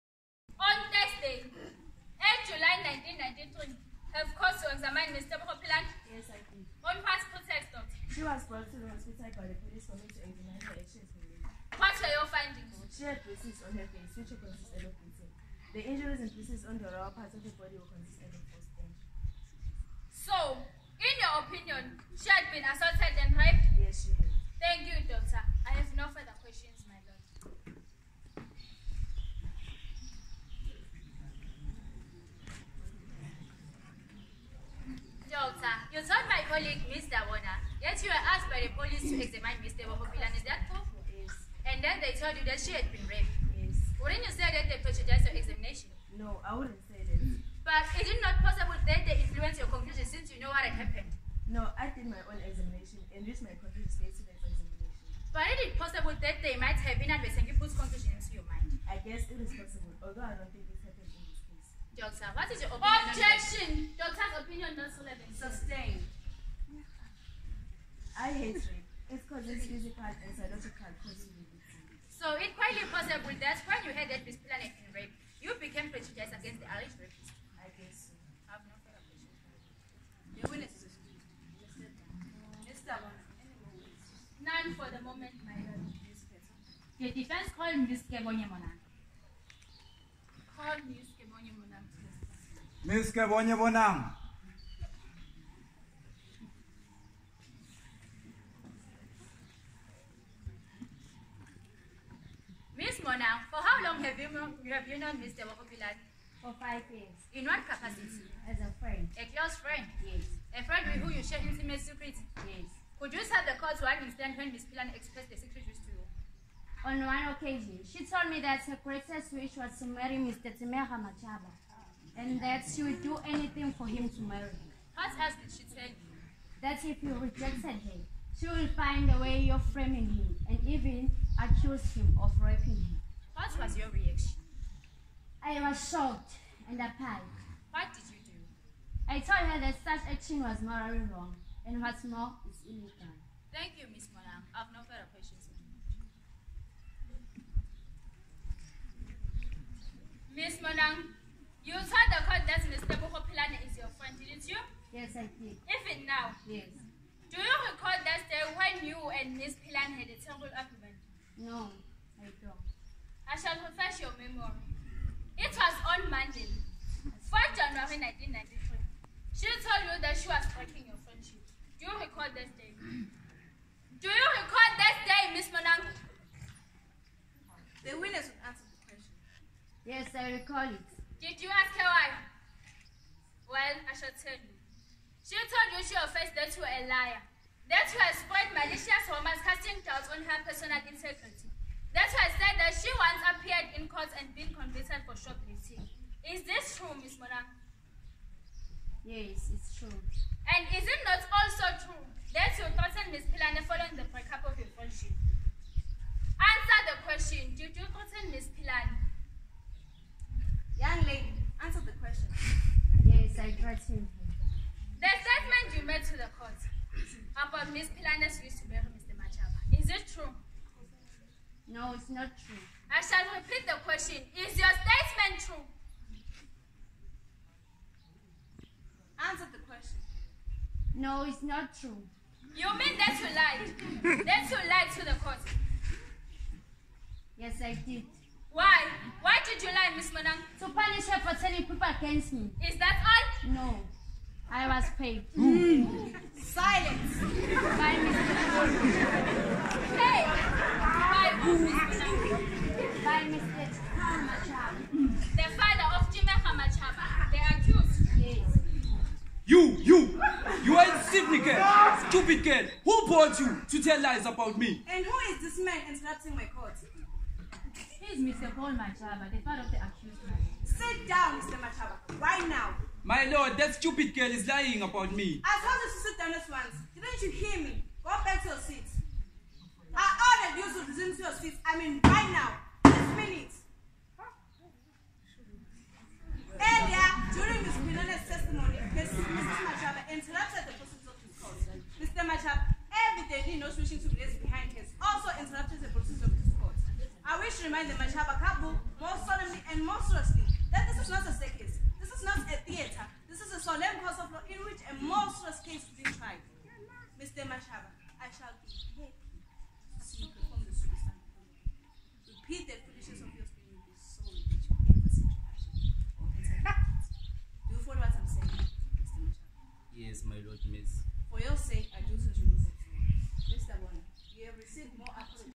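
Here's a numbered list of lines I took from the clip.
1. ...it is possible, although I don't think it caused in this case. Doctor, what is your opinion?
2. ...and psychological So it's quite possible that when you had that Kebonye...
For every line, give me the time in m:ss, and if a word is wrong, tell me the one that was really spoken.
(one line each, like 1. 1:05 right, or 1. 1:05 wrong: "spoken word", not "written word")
1. 0:59 wrong: "happened", not "caused"
2. 1:10 wrong: "Miss", not "Kebonye".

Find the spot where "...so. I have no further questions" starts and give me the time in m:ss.
1:18.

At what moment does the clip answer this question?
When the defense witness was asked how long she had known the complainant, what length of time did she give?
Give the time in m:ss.
1:46.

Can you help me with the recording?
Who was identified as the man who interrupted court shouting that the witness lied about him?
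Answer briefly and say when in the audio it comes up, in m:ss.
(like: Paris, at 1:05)
Paul Machaba, at 4:28.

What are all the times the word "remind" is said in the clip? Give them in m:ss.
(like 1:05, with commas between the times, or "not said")
4:57.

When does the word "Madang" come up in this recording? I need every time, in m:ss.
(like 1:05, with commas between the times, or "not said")
4:00, 4:08.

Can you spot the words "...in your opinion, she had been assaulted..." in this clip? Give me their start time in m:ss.
0:21.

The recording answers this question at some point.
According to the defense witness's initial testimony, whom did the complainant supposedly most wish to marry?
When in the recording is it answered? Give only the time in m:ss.
2:00.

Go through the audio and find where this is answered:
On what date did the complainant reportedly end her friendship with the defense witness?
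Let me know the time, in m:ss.
2:46.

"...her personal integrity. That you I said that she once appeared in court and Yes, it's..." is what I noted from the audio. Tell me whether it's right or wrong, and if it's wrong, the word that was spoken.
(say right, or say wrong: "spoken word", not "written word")
right.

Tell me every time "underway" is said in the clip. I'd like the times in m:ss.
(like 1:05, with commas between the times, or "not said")
not said.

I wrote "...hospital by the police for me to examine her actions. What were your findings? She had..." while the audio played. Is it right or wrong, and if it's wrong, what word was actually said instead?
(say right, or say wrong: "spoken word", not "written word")
right.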